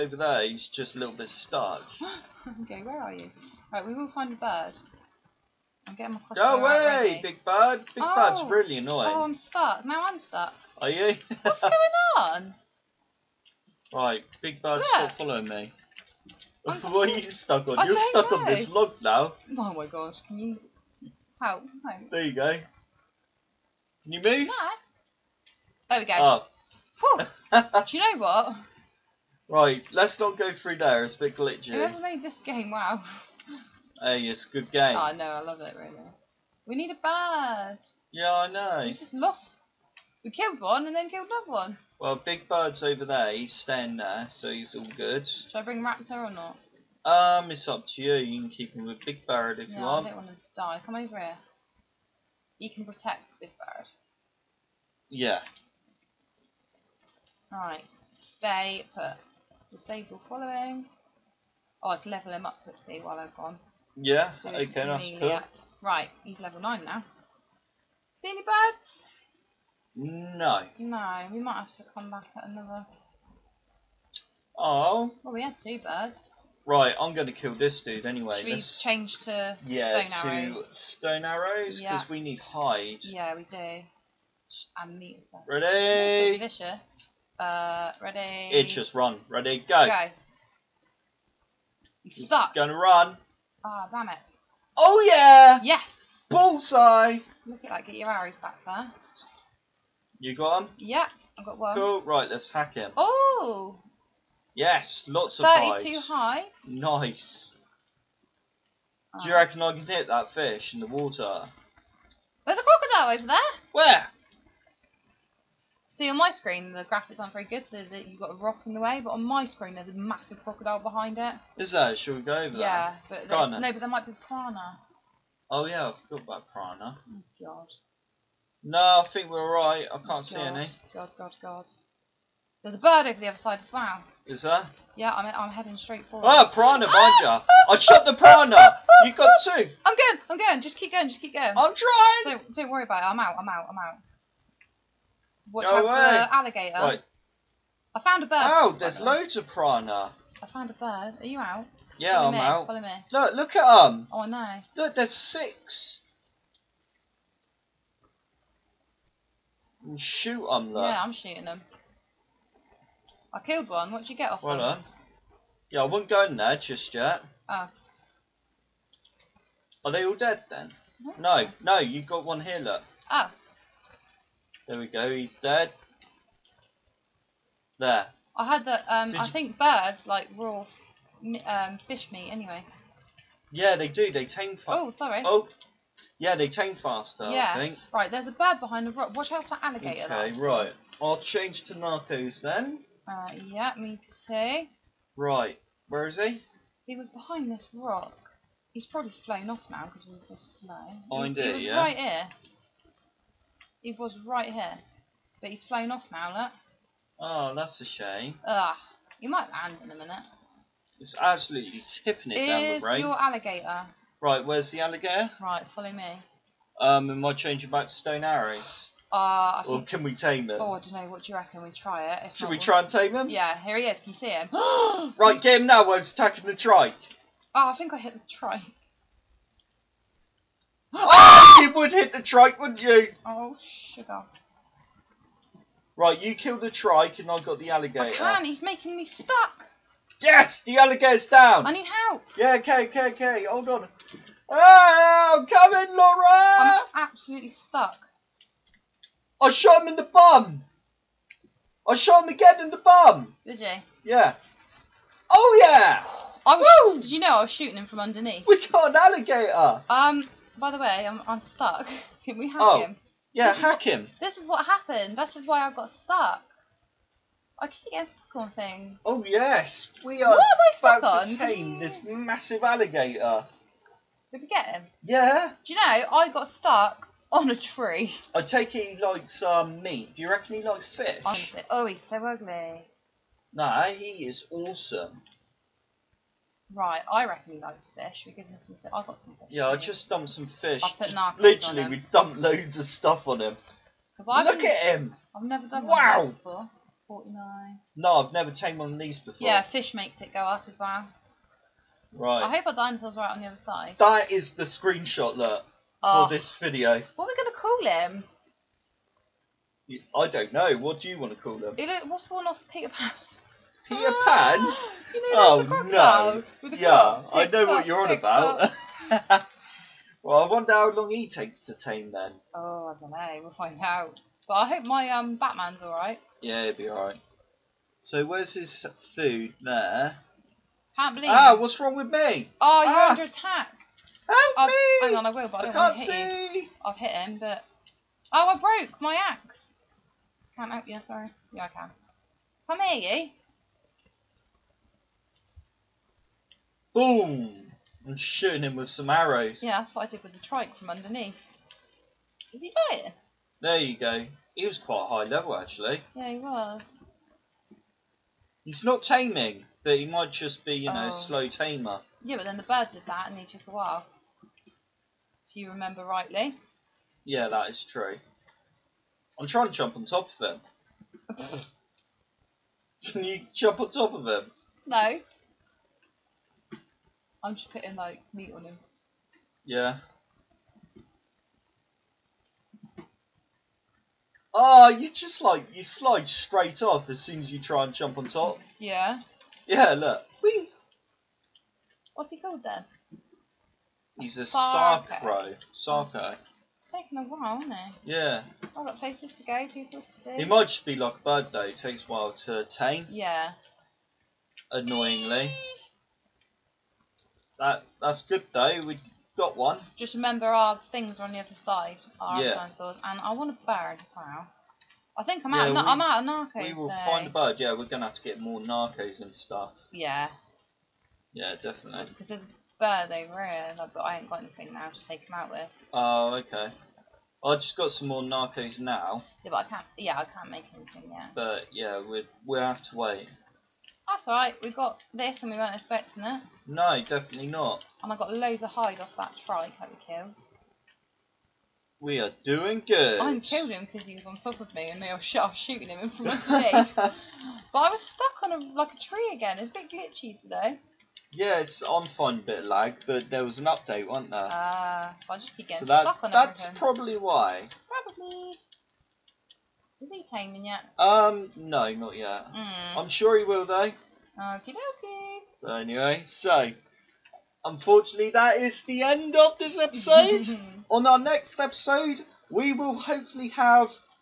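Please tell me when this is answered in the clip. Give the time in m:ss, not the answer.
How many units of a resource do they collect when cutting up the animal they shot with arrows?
1:45.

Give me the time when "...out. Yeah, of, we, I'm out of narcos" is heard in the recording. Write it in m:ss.
6:55.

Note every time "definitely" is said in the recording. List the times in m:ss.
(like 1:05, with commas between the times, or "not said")
7:01, 7:17.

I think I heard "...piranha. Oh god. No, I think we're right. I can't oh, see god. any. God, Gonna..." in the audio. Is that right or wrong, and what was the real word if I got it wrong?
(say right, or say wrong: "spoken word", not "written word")
wrong: "God", not "Gonna".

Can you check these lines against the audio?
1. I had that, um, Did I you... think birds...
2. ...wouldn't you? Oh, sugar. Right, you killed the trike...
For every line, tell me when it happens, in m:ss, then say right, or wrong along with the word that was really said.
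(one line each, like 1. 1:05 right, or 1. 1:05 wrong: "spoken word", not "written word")
1. 2:58 right
2. 3:52 right.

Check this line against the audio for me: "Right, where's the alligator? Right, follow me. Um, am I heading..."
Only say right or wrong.
wrong.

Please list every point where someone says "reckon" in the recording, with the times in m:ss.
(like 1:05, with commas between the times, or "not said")
1:49, 3:41, 4:40, 4:47.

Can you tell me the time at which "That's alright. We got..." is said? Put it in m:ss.
7:14.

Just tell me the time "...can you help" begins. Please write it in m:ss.
0:20.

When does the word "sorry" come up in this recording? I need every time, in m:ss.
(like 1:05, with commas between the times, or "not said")
3:04, 5:41.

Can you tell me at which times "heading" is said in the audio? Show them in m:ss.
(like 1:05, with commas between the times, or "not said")
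2:15.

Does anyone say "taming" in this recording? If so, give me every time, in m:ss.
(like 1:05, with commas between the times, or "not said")
5:59, 7:40.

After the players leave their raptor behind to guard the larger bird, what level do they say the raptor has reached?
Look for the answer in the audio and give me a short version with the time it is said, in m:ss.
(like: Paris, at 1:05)
9, at 1:06.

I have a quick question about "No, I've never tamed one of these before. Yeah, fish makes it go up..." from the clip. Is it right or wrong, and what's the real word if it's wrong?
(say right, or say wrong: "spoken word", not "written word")
right.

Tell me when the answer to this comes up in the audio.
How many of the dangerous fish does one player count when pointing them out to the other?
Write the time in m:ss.
2:35.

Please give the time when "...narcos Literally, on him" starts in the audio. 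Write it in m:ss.
4:51.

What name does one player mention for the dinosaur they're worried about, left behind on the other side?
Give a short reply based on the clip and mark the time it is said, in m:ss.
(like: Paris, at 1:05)
Batman, at 5:25.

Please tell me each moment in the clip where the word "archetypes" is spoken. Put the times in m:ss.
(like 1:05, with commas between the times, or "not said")
not said.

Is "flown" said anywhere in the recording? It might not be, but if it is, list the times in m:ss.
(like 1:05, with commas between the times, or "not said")
3:19, 3:25.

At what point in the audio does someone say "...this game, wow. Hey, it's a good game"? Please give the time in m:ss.
0:32.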